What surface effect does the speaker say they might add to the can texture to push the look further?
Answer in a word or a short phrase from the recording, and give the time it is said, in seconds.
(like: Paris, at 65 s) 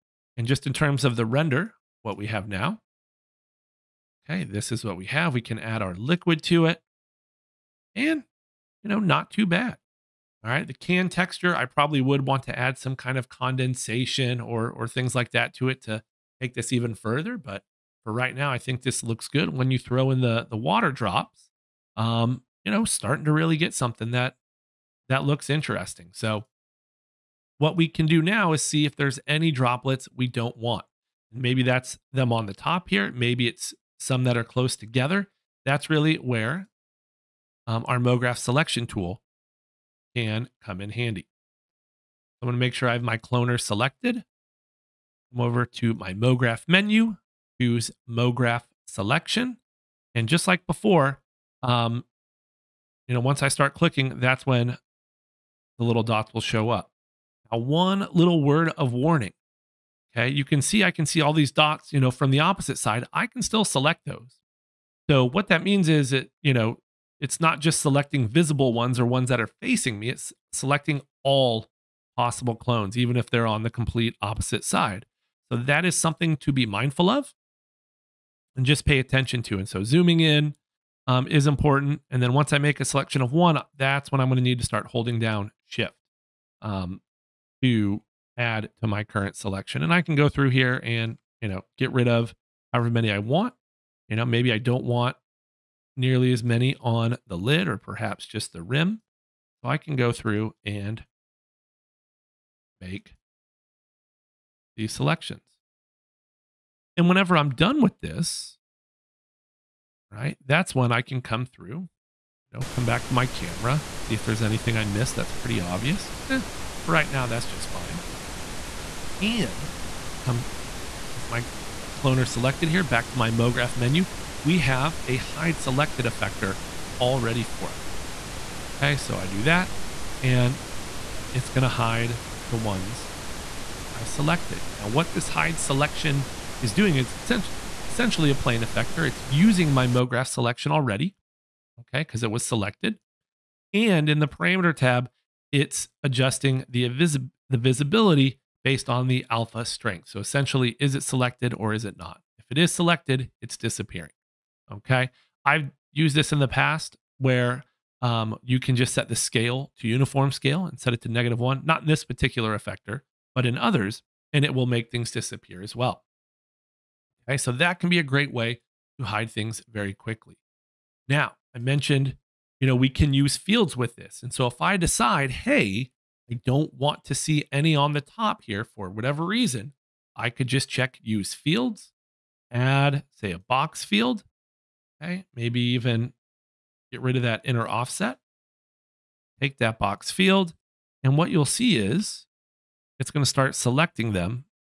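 Condensation, at 13 s.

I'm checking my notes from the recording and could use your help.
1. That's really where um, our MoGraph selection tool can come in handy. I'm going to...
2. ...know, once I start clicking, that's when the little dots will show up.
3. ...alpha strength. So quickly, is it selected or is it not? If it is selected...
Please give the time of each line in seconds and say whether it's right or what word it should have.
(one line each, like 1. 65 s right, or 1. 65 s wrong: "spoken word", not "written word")
1. 35 s right
2. 53 s right
3. 149 s wrong: "essentially", not "quickly".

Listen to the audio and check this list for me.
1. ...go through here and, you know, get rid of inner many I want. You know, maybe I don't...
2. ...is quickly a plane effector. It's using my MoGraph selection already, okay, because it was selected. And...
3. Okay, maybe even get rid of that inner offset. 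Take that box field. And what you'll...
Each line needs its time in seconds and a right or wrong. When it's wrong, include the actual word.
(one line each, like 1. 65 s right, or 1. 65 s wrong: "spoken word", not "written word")
1. 90 s wrong: "however", not "inner"
2. 136 s wrong: "essentially", not "quickly"
3. 185 s right.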